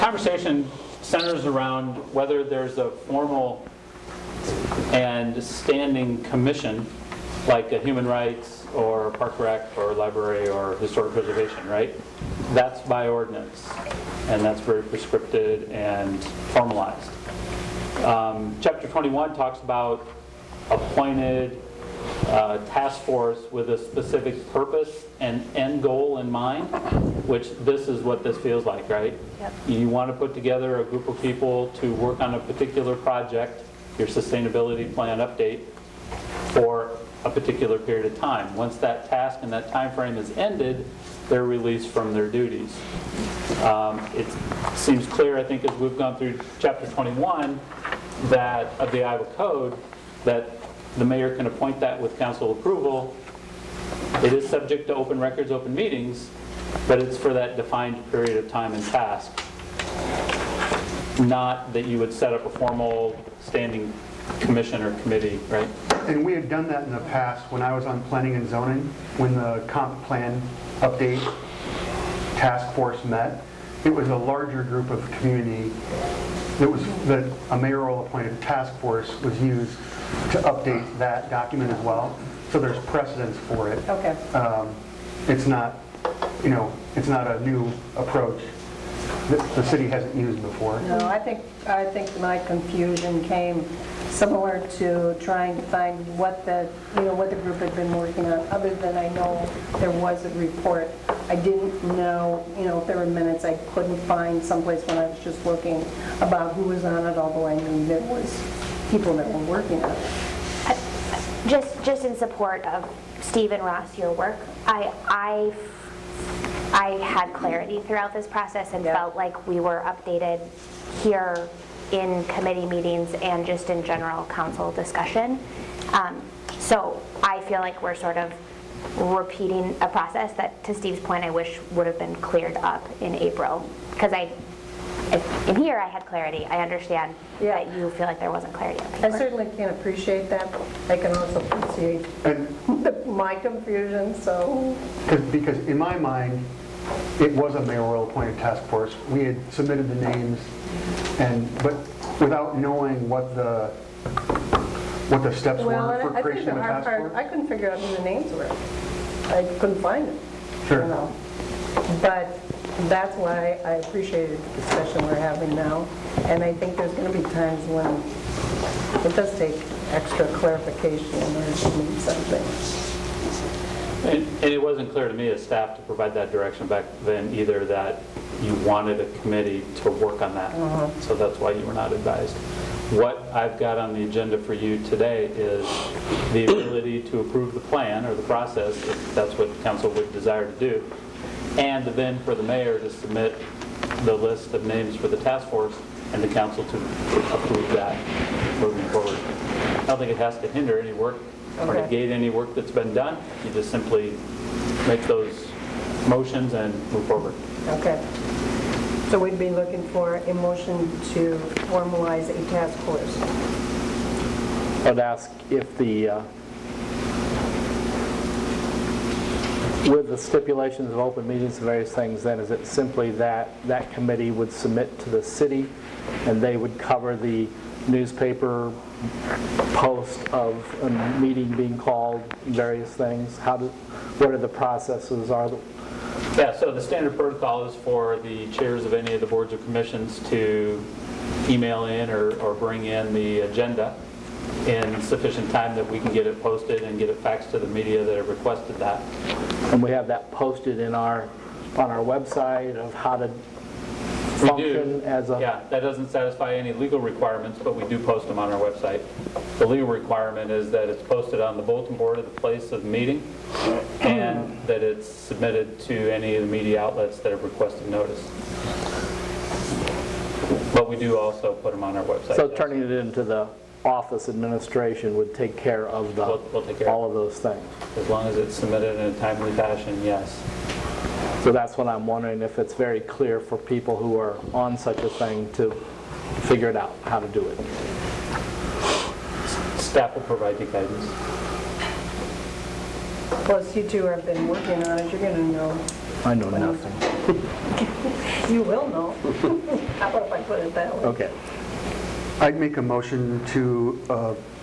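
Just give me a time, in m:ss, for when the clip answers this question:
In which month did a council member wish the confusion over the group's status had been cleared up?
2:13.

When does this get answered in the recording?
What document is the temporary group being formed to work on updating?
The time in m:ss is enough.
0:34.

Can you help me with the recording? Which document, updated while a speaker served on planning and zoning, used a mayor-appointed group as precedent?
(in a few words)
comp plan.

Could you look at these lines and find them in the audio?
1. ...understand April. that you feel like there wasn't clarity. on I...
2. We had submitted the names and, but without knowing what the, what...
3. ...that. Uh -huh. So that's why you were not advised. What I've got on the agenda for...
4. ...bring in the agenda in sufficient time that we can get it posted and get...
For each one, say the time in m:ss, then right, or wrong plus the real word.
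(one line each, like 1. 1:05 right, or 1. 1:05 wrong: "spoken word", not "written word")
1. 2:16 wrong: "Yeah", not "April"
2. 2:29 right
3. 3:00 right
4. 4:02 right.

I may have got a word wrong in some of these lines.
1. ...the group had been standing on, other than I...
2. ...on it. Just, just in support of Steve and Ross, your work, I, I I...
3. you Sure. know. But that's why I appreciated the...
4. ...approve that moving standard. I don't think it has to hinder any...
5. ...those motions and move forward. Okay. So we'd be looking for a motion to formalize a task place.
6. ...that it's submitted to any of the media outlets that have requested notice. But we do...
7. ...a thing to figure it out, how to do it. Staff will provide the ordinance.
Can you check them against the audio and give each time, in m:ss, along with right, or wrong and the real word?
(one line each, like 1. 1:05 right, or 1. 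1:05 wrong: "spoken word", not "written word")
1. 1:37 wrong: "working", not "standing"
2. 1:49 right
3. 2:40 right
4. 3:17 wrong: "forward", not "standard"
5. 3:25 wrong: "force", not "place"
6. 4:24 right
7. 4:45 wrong: "guidance", not "ordinance".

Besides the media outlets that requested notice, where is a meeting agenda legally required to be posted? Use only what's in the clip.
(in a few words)
bulletin board.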